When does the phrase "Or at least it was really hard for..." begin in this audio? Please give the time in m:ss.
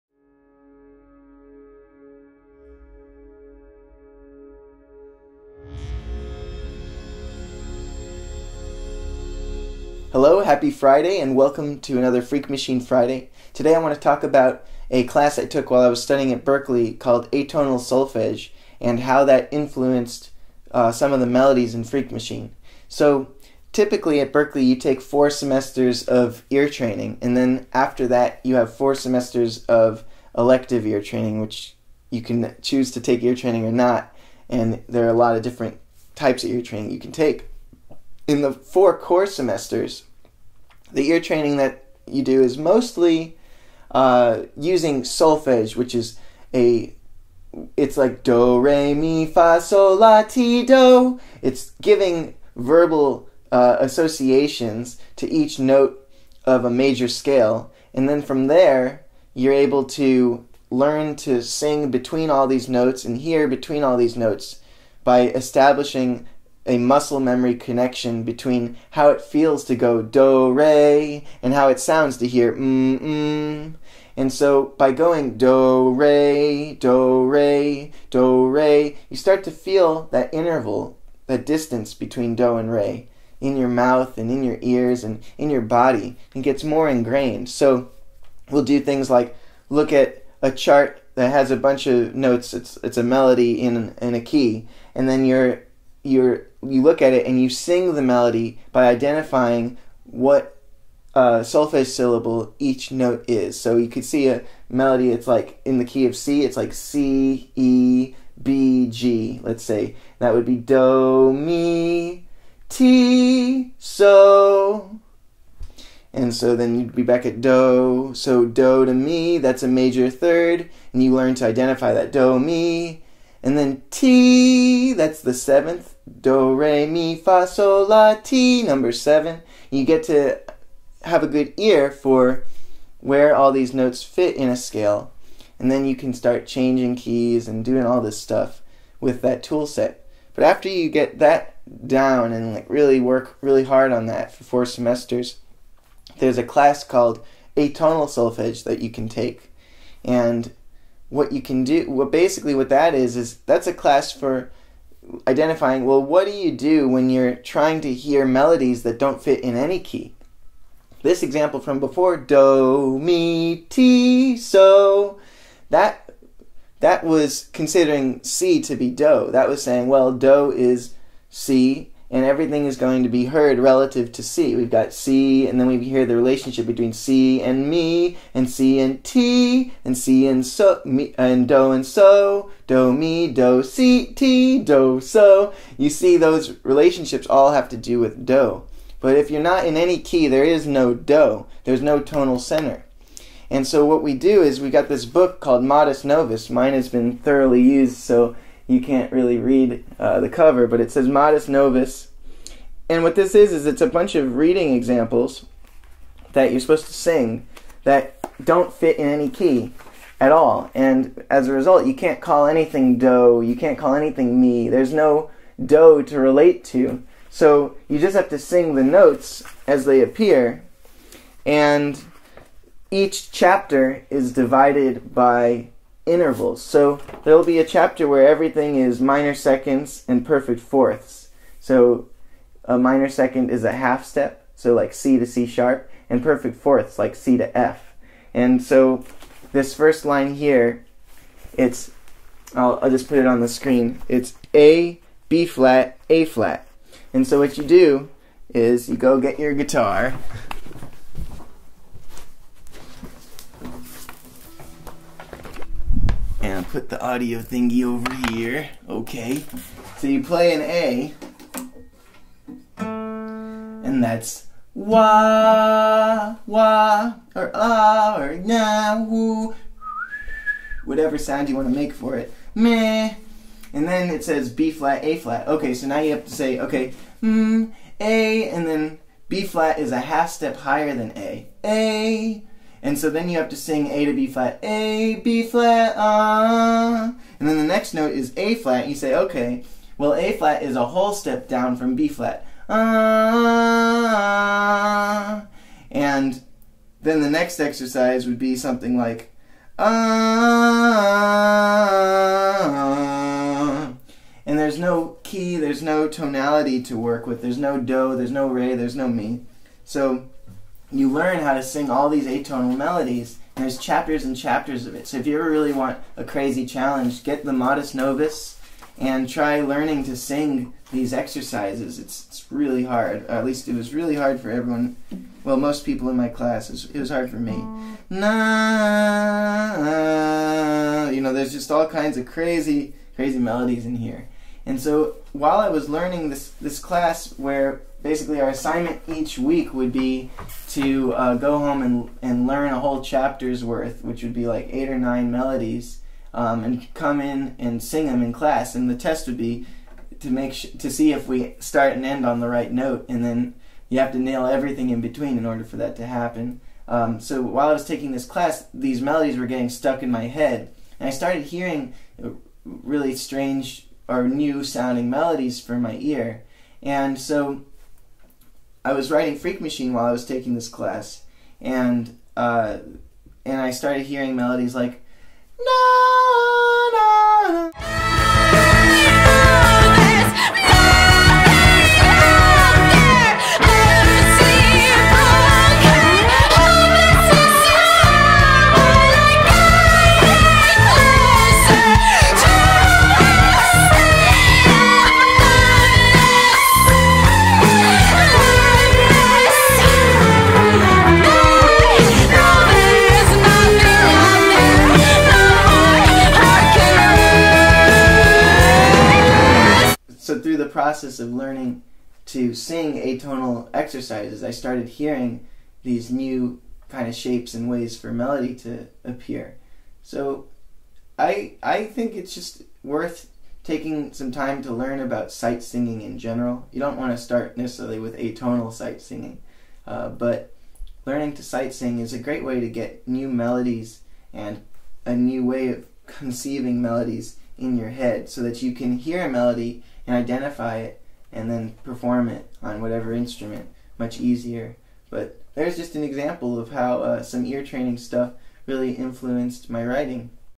5:23.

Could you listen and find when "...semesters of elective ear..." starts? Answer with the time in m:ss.
0:28.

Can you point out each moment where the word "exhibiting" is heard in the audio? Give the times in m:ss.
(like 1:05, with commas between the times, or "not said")
not said.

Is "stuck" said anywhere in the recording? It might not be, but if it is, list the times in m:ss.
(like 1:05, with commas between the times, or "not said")
5:59.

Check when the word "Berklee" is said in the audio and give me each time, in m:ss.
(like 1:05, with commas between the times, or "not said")
0:16, 0:24.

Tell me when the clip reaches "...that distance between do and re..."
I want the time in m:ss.
1:21.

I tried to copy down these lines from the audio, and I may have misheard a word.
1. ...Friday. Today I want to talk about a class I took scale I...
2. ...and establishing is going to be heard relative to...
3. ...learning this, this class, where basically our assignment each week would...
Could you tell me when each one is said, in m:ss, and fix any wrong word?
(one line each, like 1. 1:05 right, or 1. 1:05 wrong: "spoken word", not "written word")
1. 0:12 wrong: "while", not "scale"
2. 2:52 wrong: "everything", not "establishing"
3. 5:35 right.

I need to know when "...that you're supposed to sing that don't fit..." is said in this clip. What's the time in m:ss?
3:26.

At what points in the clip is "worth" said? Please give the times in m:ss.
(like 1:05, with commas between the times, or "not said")
5:43, 7:02.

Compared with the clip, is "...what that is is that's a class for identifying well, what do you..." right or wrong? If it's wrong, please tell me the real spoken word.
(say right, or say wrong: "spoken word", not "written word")
right.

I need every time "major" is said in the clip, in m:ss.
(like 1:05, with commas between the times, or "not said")
0:56, 1:59.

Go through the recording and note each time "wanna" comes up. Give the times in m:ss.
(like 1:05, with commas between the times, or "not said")
4:31.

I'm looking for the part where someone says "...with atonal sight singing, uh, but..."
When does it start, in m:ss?
7:07.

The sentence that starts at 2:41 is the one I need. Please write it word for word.
This example from before, do, mi, ti, so, that, that was considering C to be do.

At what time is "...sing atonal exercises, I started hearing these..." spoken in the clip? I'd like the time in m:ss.
6:52.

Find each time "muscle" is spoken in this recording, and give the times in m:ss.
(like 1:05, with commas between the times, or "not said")
1:06.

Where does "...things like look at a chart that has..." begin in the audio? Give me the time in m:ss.
1:28.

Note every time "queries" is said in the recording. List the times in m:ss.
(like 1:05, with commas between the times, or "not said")
not said.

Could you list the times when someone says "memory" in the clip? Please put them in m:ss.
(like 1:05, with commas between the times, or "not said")
1:07.